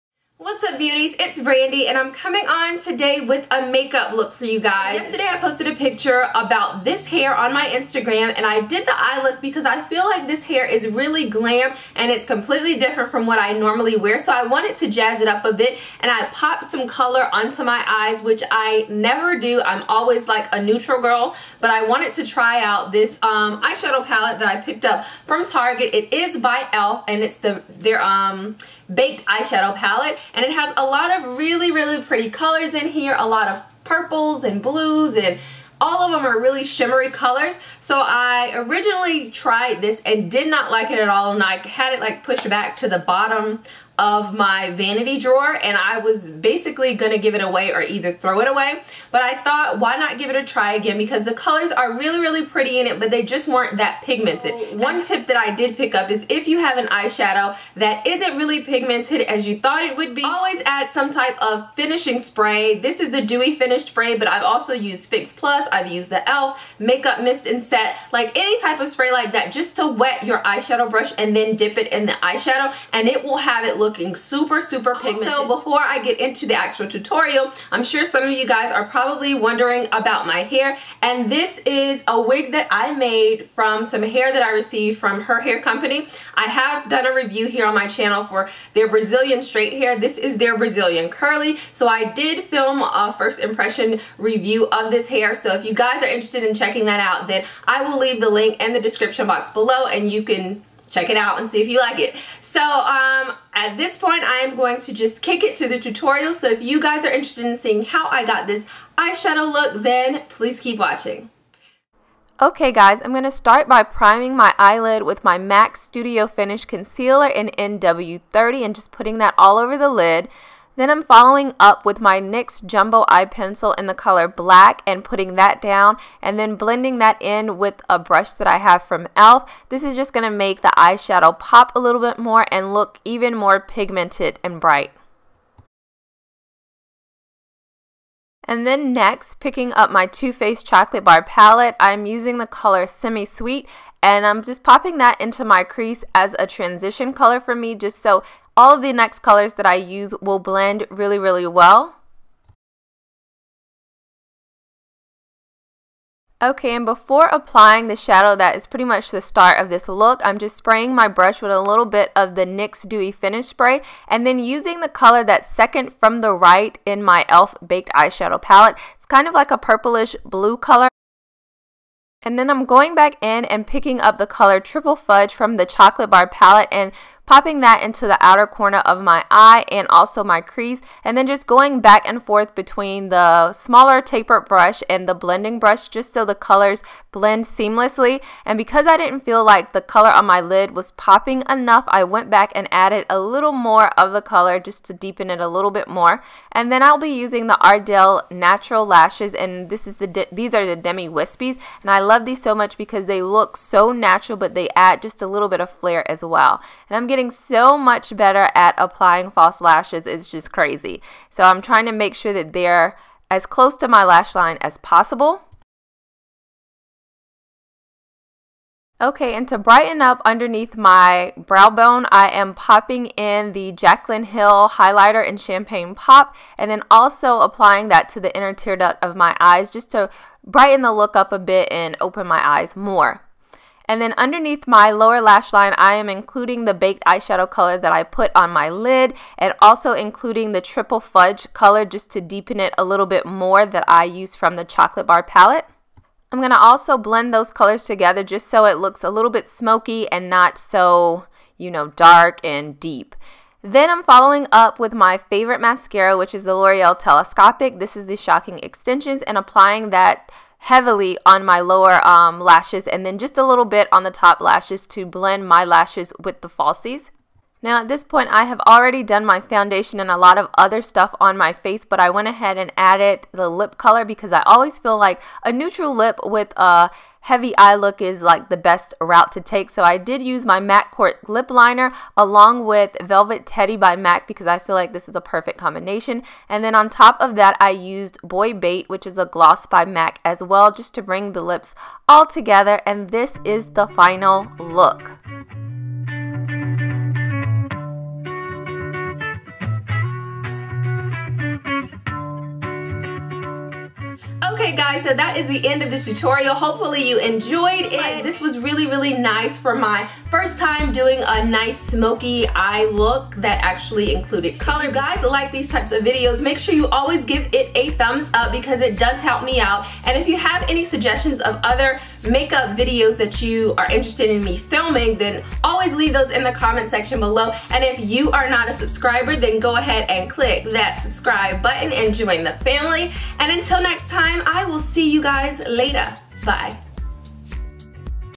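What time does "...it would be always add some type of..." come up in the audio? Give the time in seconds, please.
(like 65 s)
59 s.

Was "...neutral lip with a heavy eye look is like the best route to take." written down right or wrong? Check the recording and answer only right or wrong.
right.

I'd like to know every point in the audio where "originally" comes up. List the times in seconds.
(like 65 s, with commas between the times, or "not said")
38 s.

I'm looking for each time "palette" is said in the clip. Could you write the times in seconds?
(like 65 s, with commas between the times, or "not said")
24 s, 29 s, 141 s, 168 s, 176 s, 245 s.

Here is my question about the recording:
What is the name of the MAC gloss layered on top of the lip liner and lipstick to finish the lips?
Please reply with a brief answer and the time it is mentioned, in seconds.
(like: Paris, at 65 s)
Boy Bait, at 288 s.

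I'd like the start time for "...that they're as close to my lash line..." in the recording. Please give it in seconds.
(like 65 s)
212 s.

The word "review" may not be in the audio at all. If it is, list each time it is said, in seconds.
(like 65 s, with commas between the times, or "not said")
87 s, 94 s.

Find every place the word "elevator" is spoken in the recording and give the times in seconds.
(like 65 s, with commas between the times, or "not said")
not said.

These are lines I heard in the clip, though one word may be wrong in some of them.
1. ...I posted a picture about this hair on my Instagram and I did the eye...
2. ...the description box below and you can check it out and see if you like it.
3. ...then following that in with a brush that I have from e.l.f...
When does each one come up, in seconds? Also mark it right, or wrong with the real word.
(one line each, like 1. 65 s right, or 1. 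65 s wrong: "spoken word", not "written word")
1. 5 s right
2. 98 s right
3. 126 s wrong: "blending", not "following".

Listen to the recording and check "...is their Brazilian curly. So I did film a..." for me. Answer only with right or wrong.
right.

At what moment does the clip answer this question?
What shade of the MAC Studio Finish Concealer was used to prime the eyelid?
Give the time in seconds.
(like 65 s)
117 s.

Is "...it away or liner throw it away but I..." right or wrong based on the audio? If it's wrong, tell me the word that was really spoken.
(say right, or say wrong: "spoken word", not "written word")
wrong: "either", not "liner".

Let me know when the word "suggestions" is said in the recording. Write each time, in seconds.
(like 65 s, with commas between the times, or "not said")
320 s.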